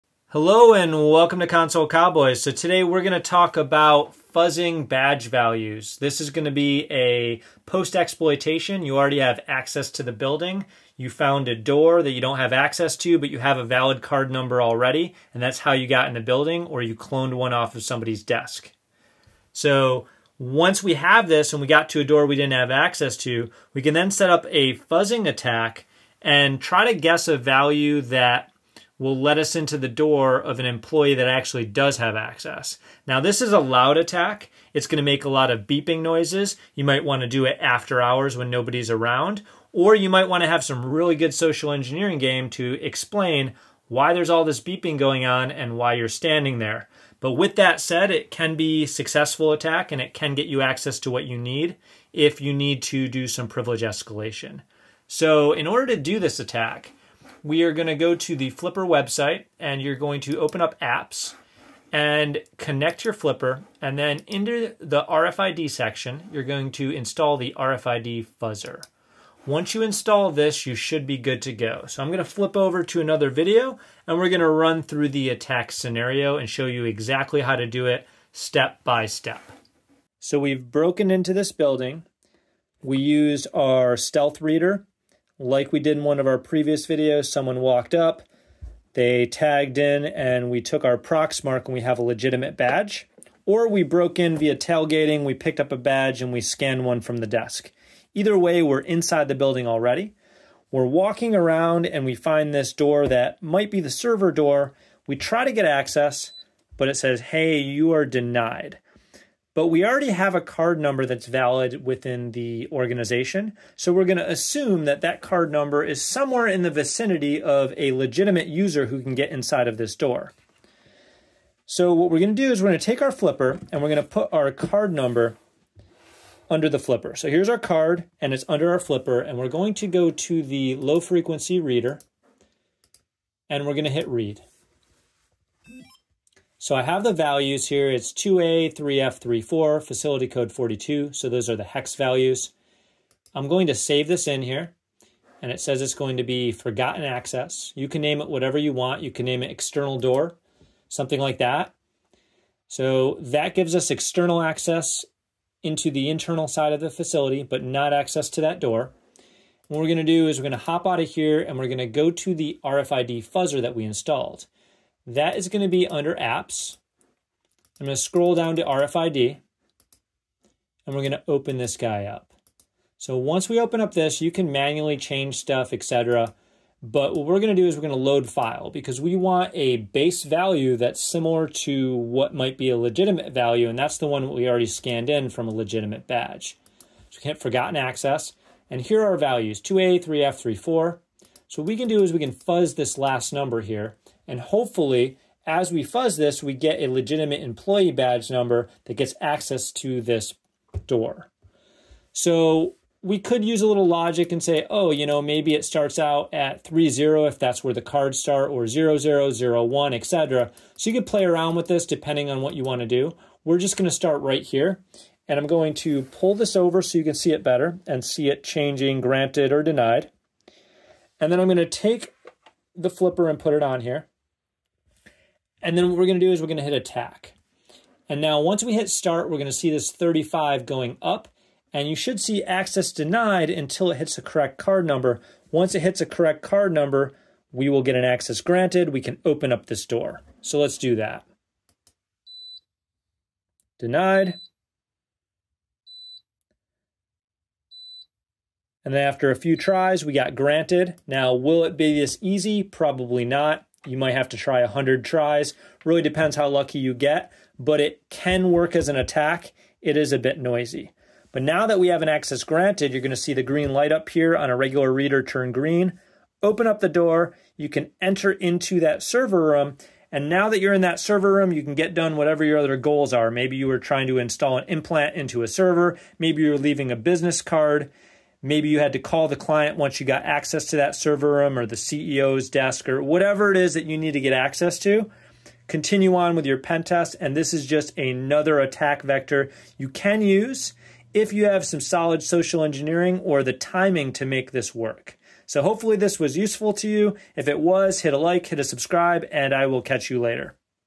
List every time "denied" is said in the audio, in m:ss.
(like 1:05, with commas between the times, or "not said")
1:48, 3:39, 3:52, 4:03.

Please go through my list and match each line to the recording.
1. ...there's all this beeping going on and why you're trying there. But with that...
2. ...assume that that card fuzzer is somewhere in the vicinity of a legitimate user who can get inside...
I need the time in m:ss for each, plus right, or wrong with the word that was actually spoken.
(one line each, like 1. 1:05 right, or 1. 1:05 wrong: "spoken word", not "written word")
1. 0:44 wrong: "standing", not "trying"
2. 1:54 wrong: "number", not "fuzzer".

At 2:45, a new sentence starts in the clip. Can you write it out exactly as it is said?
That is going to be under apps.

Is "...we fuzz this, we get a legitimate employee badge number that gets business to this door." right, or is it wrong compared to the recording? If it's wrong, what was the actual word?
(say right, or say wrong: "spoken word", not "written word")
wrong: "access", not "business".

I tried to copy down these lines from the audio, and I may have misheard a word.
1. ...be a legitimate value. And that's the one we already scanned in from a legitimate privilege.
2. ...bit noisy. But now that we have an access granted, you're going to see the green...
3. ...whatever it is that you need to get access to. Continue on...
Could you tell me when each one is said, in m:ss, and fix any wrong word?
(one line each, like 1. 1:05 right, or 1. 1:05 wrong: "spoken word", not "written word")
1. 3:02 wrong: "badge", not "privilege"
2. 4:20 right
3. 4:43 right.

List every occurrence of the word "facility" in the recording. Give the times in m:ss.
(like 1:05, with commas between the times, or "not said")
2:19, 2:36.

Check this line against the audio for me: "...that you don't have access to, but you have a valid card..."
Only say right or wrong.
right.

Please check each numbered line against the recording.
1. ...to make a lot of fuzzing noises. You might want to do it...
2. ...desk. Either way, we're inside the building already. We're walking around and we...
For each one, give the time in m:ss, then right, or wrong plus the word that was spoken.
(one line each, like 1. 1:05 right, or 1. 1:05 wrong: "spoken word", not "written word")
1. 0:34 wrong: "beeping", not "fuzzing"
2. 1:37 right.